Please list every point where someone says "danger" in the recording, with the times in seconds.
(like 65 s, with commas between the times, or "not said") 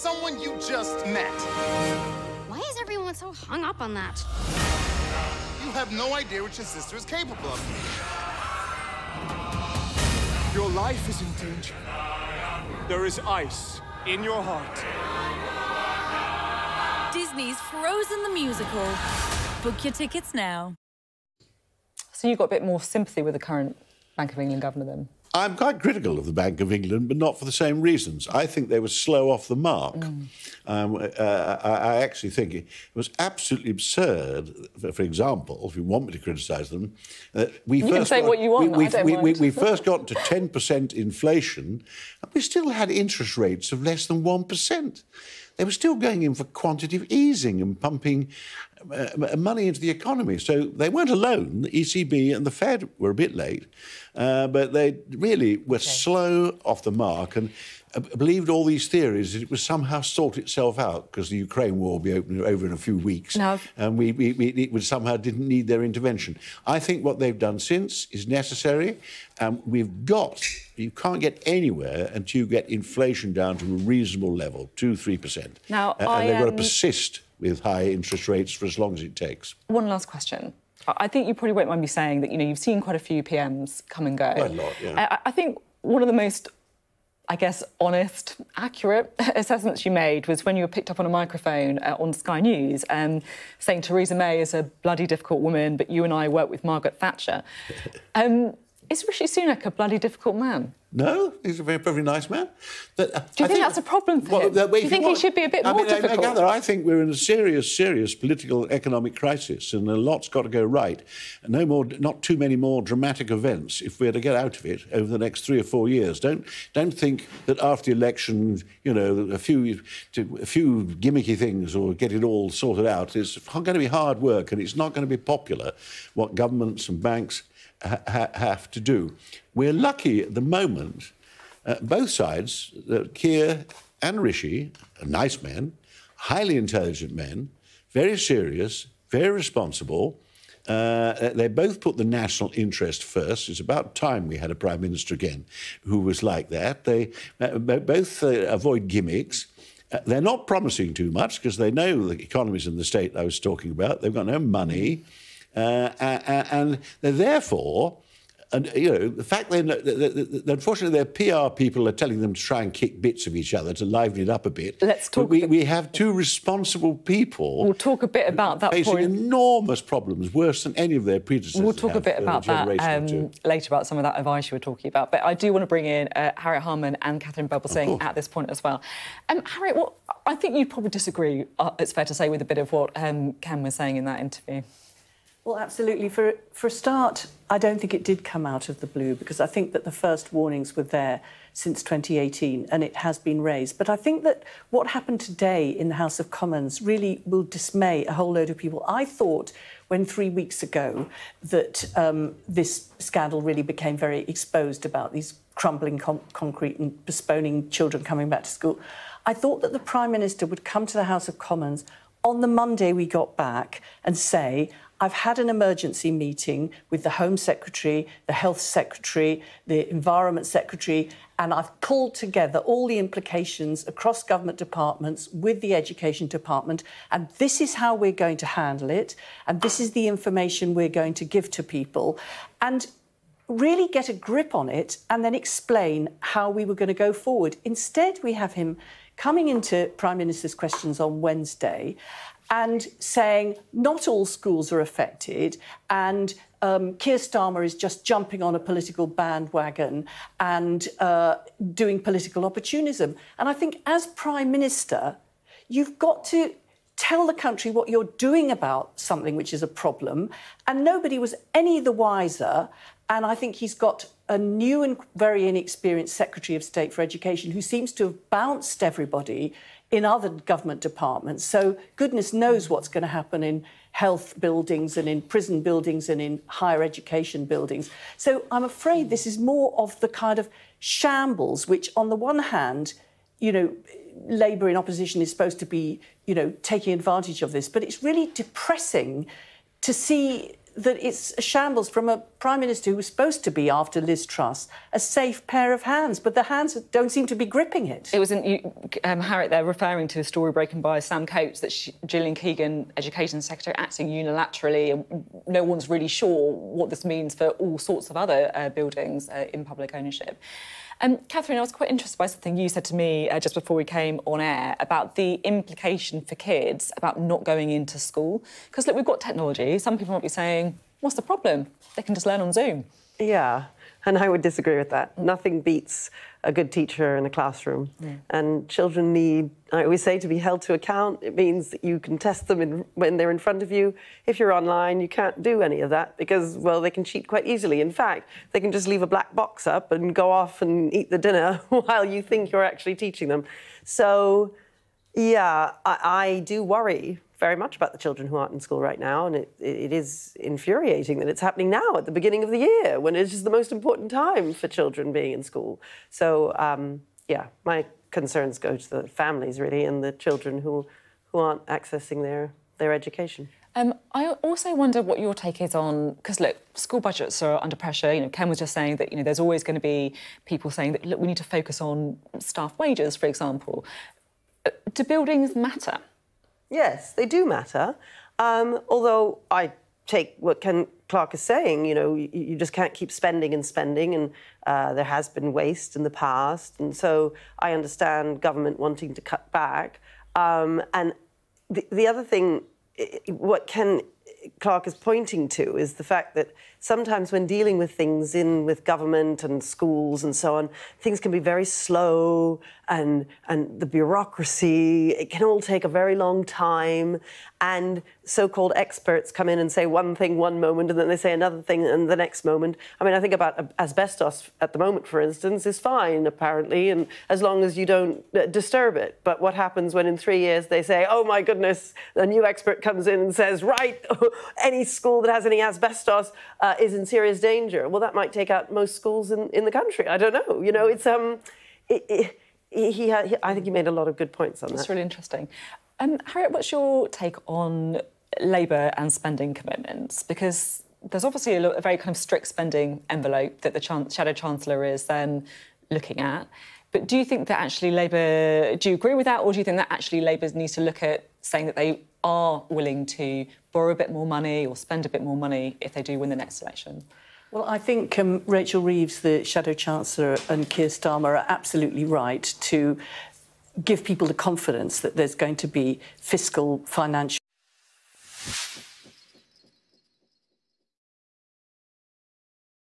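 11 s, 427 s.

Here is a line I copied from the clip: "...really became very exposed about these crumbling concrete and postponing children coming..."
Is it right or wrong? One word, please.
right.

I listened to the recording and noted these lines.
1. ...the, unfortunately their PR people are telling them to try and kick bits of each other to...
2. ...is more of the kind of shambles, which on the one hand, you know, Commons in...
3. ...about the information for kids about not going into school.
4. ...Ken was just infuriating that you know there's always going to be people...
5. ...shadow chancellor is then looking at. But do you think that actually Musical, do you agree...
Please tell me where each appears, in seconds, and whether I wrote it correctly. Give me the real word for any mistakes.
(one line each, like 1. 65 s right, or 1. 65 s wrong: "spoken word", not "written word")
1. 159 s right
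2. 279 s wrong: "Labour", not "Commons"
3. 314 s wrong: "implication", not "information"
4. 368 s wrong: "saying", not "infuriating"
5. 444 s wrong: "Labour", not "Musical".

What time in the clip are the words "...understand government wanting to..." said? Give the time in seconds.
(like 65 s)
387 s.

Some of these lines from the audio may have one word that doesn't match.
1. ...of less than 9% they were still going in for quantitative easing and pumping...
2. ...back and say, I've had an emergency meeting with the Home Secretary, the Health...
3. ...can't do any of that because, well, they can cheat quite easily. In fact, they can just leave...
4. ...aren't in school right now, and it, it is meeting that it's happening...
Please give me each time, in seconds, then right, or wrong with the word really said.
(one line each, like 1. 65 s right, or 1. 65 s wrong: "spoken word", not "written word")
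1. 43 s wrong: "1", not "9"
2. 213 s right
3. 335 s right
4. 348 s wrong: "infuriating", not "meeting".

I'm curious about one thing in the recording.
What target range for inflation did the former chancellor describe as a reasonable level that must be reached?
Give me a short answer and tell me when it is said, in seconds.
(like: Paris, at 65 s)
two, three percent, at 74 s.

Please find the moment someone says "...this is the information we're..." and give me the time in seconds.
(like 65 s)
229 s.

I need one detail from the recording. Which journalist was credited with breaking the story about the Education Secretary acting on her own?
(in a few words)
Sam Coates.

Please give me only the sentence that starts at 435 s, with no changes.
Um, Harriet, what's your take on Labour and spending commitments?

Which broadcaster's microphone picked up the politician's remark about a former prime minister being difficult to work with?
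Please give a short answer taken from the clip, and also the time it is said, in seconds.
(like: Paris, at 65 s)
Sky News, at 92 s.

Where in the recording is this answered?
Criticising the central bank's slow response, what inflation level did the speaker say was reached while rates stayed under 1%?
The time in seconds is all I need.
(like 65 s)
40 s.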